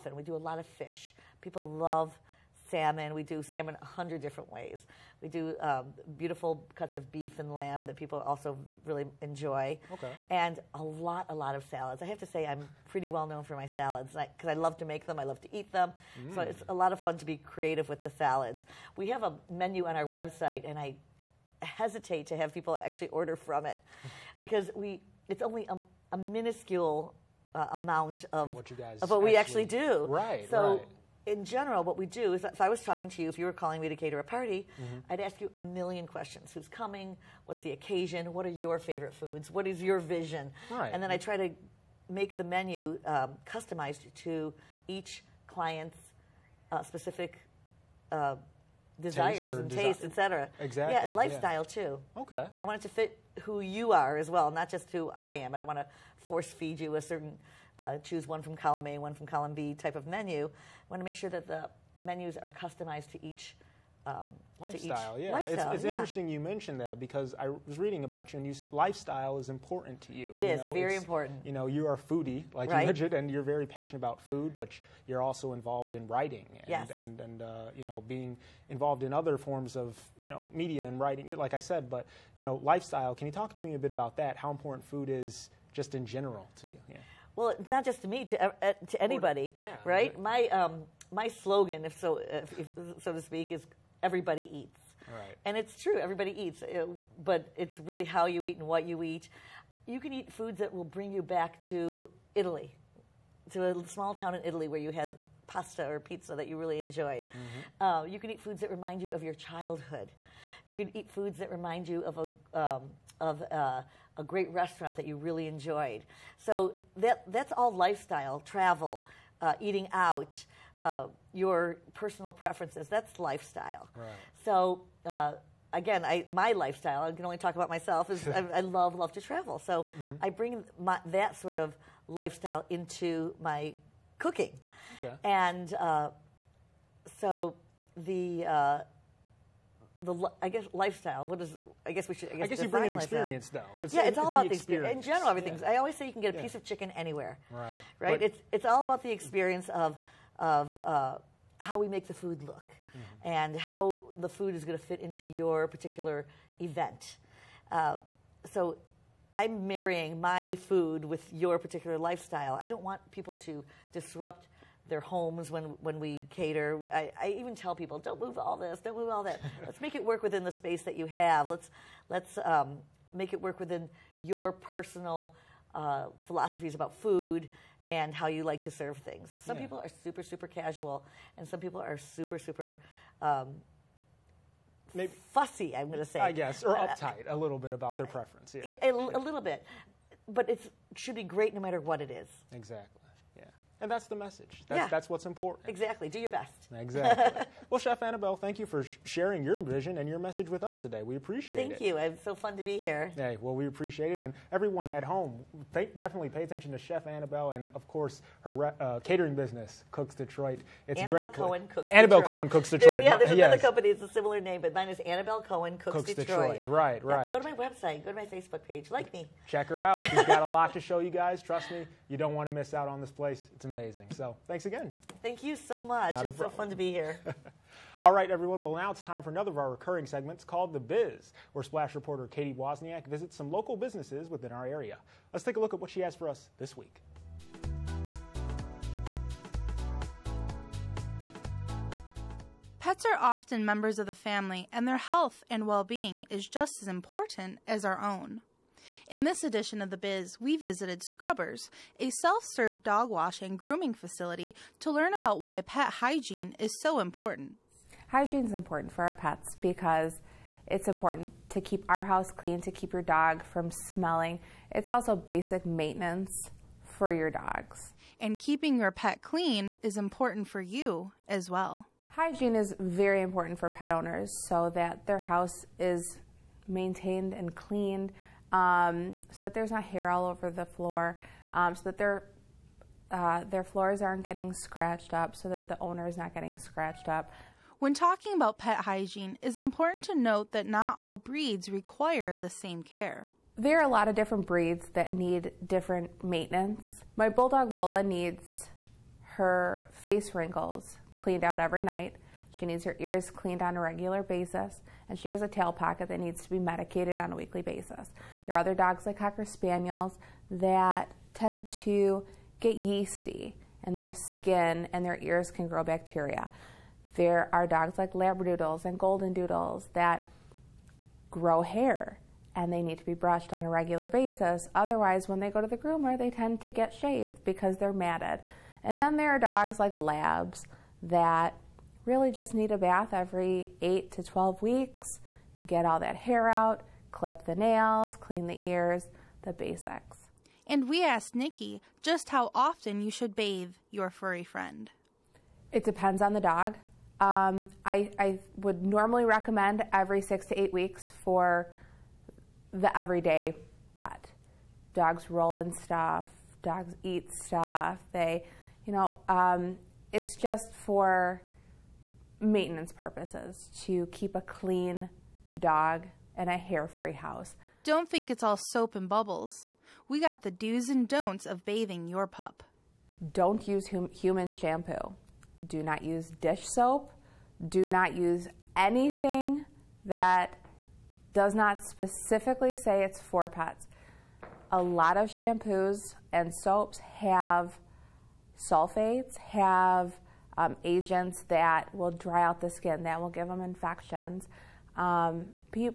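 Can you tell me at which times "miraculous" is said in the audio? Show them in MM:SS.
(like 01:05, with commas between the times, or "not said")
not said.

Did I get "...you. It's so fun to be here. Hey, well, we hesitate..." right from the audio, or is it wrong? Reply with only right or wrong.
wrong.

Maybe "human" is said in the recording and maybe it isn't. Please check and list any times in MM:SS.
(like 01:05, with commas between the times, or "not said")
06:14.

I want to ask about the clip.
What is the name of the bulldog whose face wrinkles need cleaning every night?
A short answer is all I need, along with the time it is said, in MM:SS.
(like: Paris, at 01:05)
Lola, at 04:57.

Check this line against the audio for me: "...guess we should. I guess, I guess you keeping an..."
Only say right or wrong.
wrong.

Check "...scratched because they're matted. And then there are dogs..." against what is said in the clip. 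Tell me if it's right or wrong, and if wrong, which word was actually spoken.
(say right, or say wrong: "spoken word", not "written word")
wrong: "shaved", not "scratched".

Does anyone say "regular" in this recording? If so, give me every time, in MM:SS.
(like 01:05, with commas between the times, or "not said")
05:03, 05:23.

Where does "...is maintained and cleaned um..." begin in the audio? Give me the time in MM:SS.
04:35.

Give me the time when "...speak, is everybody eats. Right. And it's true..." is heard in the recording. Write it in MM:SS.
01:33.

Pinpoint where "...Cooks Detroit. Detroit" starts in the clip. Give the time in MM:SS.
03:35.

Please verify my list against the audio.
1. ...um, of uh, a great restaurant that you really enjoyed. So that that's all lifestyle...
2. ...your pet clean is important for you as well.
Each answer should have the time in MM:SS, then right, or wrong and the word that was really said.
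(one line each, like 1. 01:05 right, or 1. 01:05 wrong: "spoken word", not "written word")
1. 01:52 right
2. 04:28 right.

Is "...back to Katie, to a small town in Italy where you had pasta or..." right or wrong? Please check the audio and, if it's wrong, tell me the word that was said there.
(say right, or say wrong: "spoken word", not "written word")
wrong: "Italy", not "Katie".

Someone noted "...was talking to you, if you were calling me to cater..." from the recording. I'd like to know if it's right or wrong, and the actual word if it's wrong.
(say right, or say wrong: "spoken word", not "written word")
right.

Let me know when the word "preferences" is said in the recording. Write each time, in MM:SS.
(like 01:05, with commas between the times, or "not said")
02:02, 03:08.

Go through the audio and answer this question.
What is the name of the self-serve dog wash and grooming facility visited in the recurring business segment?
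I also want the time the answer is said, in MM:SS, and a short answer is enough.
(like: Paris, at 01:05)
Scrubbers, at 04:11.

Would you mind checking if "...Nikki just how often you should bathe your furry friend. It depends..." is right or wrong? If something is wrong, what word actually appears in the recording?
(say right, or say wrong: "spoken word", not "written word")
right.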